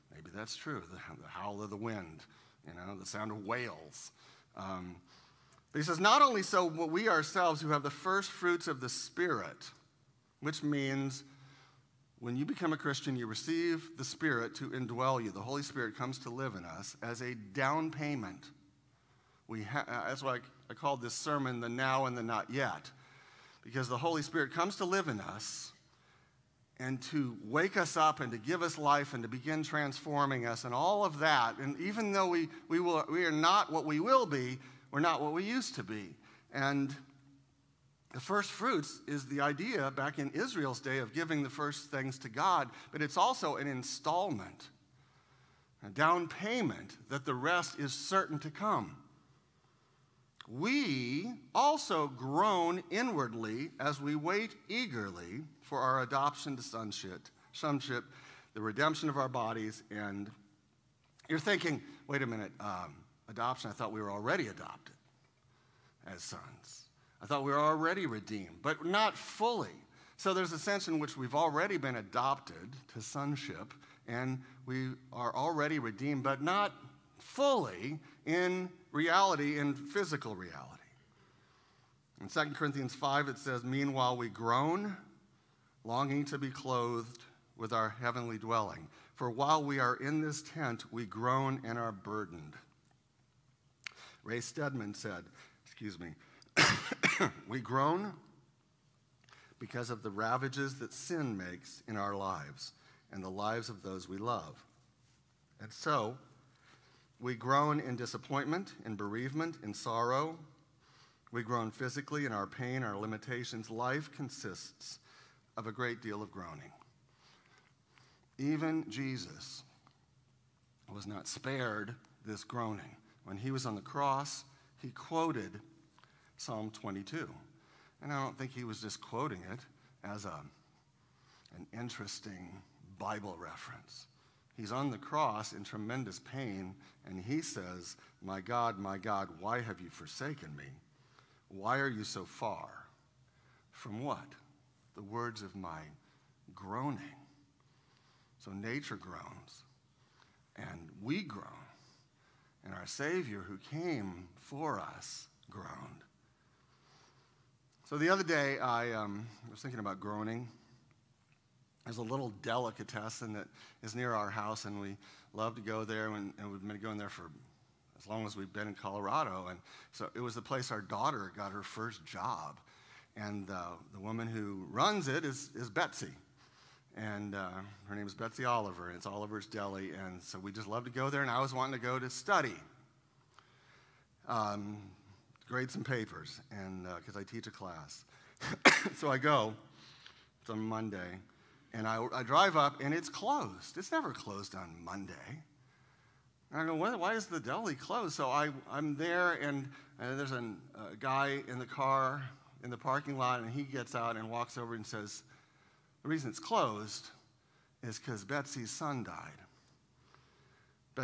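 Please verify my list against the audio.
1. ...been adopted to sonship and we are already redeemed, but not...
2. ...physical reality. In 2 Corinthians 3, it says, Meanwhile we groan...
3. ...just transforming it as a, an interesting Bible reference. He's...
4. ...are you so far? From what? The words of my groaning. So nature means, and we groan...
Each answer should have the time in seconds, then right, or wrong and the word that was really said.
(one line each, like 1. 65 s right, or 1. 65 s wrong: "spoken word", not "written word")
1. 71 s right
2. 79 s wrong: "5", not "3"
3. 128 s wrong: "quoting", not "transforming"
4. 141 s wrong: "groans", not "means".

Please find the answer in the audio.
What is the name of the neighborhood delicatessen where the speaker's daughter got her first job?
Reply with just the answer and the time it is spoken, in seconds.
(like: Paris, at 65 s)
Oliver's Deli, at 179 s.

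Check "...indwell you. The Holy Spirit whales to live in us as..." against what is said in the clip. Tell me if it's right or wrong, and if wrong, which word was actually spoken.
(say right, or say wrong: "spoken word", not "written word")
wrong: "comes", not "whales".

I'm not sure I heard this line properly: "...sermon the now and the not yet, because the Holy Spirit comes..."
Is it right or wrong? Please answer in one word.
right.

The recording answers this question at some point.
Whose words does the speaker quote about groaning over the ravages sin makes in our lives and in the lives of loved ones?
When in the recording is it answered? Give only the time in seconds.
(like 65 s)
94 s.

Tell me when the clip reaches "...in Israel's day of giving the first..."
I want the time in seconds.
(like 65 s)
40 s.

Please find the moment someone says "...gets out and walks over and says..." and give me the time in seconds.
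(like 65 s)
203 s.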